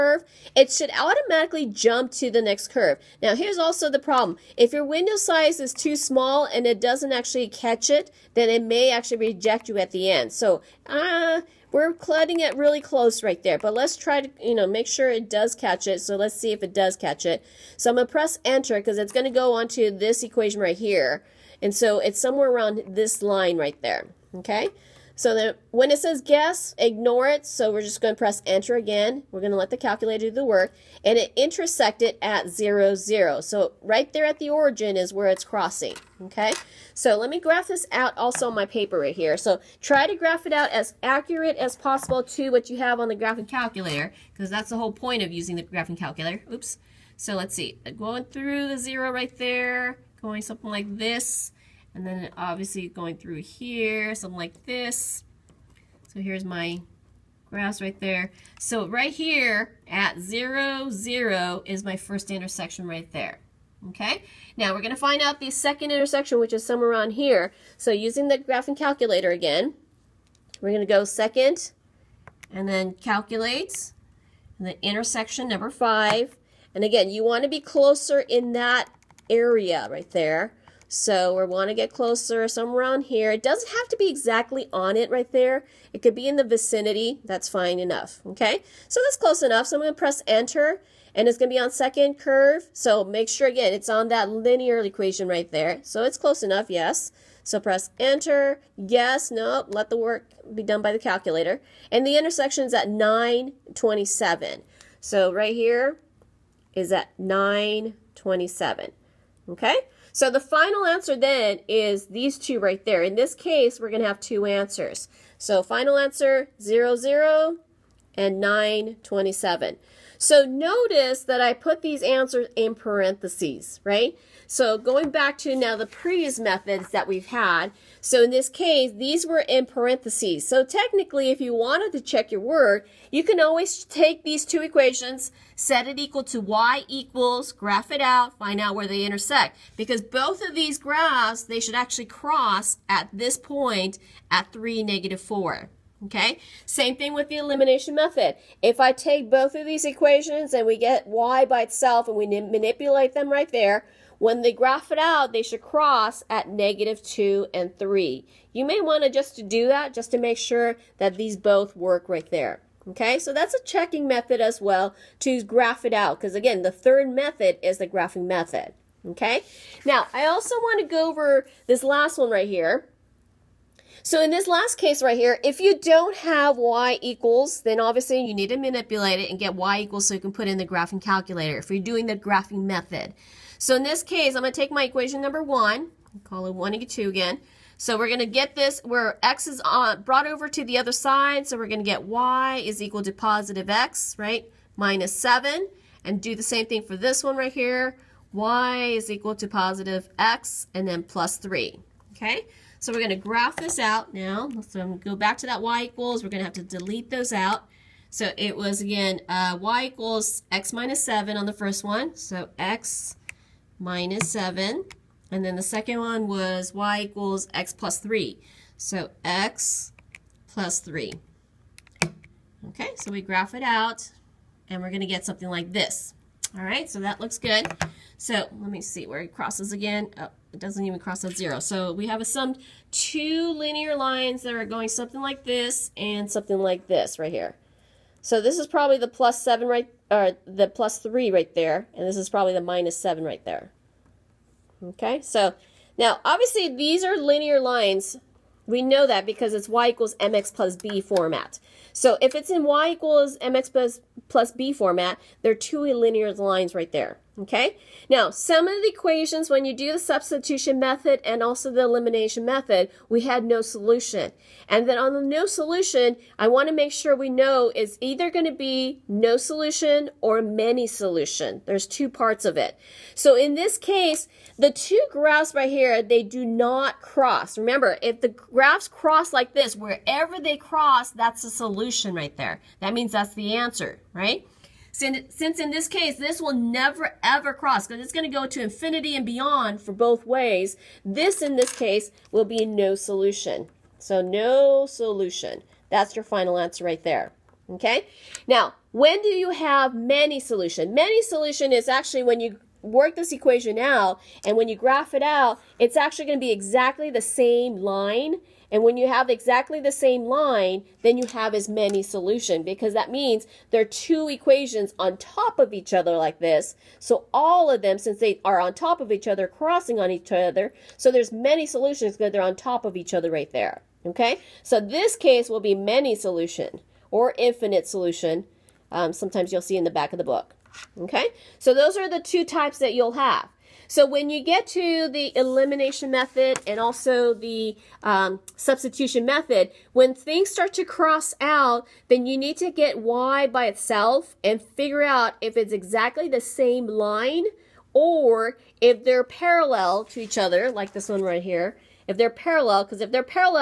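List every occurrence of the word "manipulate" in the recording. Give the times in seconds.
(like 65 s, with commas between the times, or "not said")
152 s, 178 s.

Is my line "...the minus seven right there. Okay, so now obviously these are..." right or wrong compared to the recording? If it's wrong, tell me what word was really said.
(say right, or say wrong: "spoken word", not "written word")
right.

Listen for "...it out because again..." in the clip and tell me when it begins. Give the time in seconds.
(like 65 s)
165 s.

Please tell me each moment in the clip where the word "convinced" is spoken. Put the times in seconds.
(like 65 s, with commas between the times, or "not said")
not said.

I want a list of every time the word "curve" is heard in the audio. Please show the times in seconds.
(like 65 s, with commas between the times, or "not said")
2 s, 92 s.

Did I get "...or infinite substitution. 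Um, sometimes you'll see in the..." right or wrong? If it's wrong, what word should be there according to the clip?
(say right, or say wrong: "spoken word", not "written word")
wrong: "solution", not "substitution".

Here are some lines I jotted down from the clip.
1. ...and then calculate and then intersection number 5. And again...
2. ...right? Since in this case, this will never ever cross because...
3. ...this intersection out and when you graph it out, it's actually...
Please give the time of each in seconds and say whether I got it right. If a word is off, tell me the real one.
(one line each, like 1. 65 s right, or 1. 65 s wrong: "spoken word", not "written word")
1. 72 s right
2. 284 s right
3. 303 s wrong: "equation", not "intersection".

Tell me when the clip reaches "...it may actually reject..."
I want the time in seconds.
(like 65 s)
8 s.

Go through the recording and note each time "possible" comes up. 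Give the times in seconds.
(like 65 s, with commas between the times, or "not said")
41 s.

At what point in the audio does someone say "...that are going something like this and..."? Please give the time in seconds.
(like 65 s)
234 s.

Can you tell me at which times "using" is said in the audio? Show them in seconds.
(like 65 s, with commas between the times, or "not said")
45 s, 67 s.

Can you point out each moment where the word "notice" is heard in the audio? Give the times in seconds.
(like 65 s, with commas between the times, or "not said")
120 s.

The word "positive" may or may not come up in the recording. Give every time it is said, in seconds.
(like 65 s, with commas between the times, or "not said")
193 s, 199 s.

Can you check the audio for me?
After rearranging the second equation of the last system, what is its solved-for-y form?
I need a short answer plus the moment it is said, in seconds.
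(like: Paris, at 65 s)
y = x + 3, at 198 s.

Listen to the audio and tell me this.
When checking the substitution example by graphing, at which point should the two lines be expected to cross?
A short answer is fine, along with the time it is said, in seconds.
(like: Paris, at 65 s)
(3, -4), at 144 s.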